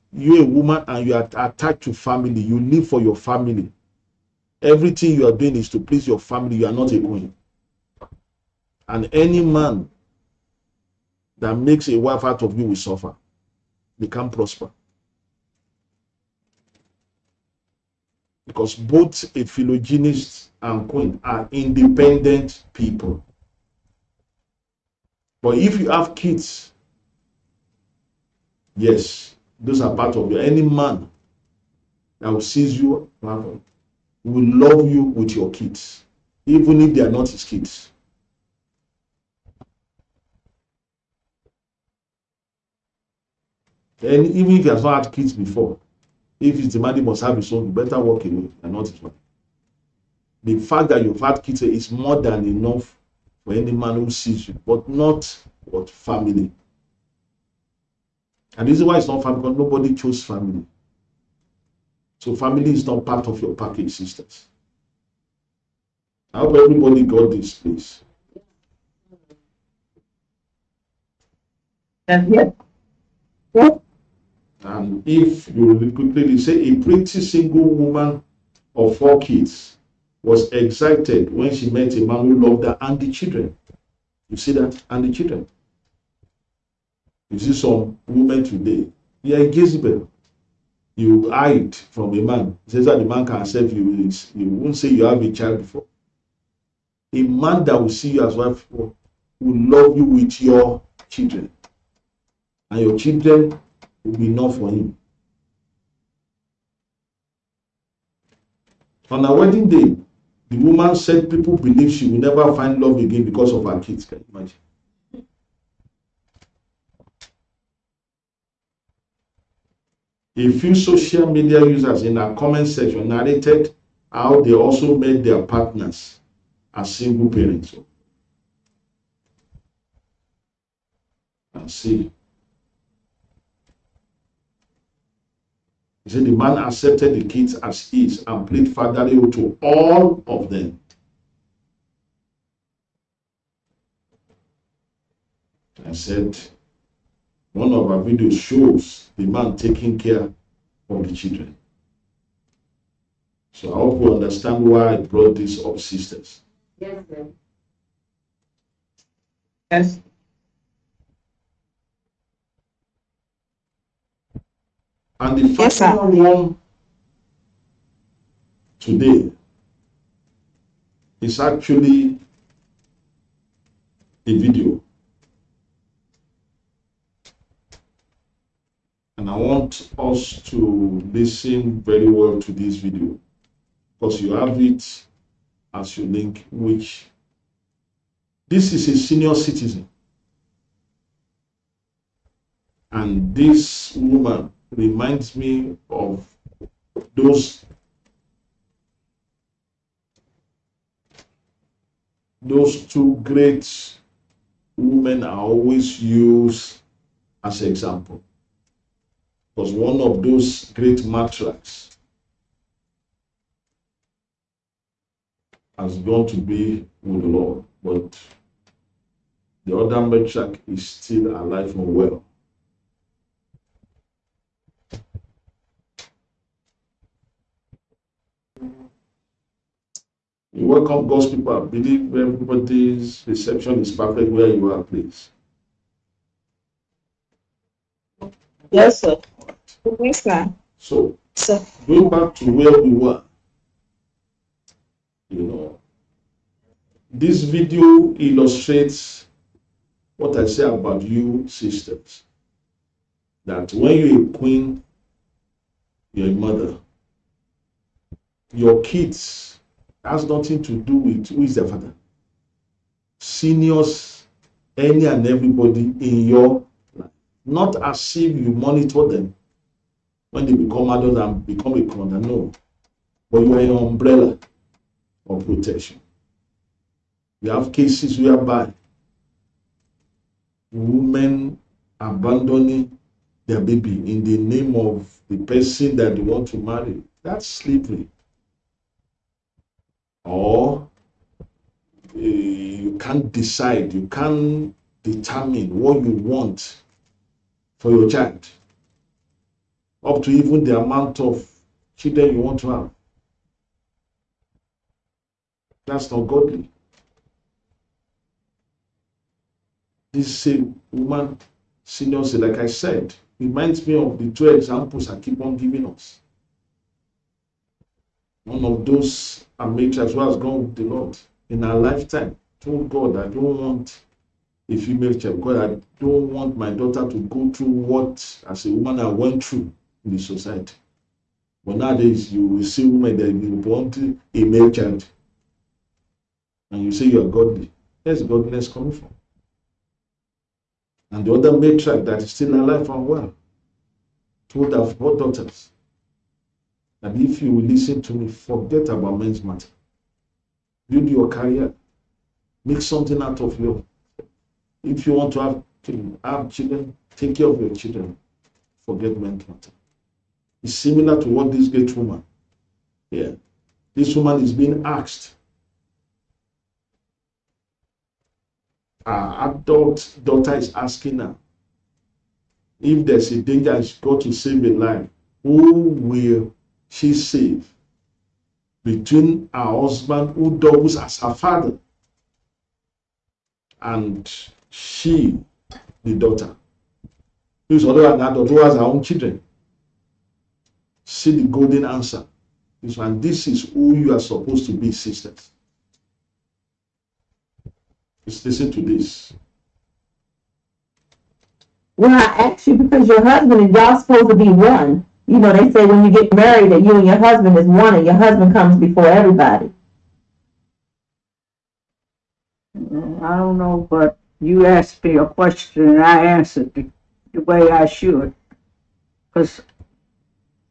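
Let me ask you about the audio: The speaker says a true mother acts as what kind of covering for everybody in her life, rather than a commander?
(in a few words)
umbrella of protection.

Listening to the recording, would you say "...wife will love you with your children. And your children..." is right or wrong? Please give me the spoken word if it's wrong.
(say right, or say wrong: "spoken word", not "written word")
right.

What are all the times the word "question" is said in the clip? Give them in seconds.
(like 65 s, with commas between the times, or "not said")
415 s.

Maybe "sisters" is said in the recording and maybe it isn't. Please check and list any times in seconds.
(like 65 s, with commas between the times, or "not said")
63 s, 155 s, 251 s, 394 s.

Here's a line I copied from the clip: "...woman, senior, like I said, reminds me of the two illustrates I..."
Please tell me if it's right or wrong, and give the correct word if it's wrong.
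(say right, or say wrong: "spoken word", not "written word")
wrong: "examples", not "illustrates".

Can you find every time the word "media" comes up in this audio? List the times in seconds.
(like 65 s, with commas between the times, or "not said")
121 s.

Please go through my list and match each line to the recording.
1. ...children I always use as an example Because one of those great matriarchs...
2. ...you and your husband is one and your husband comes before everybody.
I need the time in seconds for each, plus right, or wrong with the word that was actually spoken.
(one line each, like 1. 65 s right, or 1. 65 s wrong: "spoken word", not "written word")
1. 204 s wrong: "women", not "children"
2. 406 s right.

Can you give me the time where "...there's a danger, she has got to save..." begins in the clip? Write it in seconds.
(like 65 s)
373 s.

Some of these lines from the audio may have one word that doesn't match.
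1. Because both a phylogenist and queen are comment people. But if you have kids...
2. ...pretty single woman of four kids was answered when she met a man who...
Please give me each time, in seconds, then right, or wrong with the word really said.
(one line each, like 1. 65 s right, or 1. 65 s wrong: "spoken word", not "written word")
1. 18 s wrong: "independent", not "comment"
2. 76 s wrong: "excited", not "answered".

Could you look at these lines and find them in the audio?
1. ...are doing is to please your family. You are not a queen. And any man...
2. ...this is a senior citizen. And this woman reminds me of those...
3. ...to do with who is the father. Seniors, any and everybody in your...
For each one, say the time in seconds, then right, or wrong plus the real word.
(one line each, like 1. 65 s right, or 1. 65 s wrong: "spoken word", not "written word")
1. 5 s right
2. 188 s right
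3. 260 s right.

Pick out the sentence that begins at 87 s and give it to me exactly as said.
You see some women today, You are Jezebel.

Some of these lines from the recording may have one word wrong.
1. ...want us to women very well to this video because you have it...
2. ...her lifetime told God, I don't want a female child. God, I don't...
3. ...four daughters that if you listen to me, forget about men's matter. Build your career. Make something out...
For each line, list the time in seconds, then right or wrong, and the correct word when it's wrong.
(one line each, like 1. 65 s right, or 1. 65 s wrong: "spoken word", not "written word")
1. 179 s wrong: "listen", not "women"
2. 321 s right
3. 344 s right.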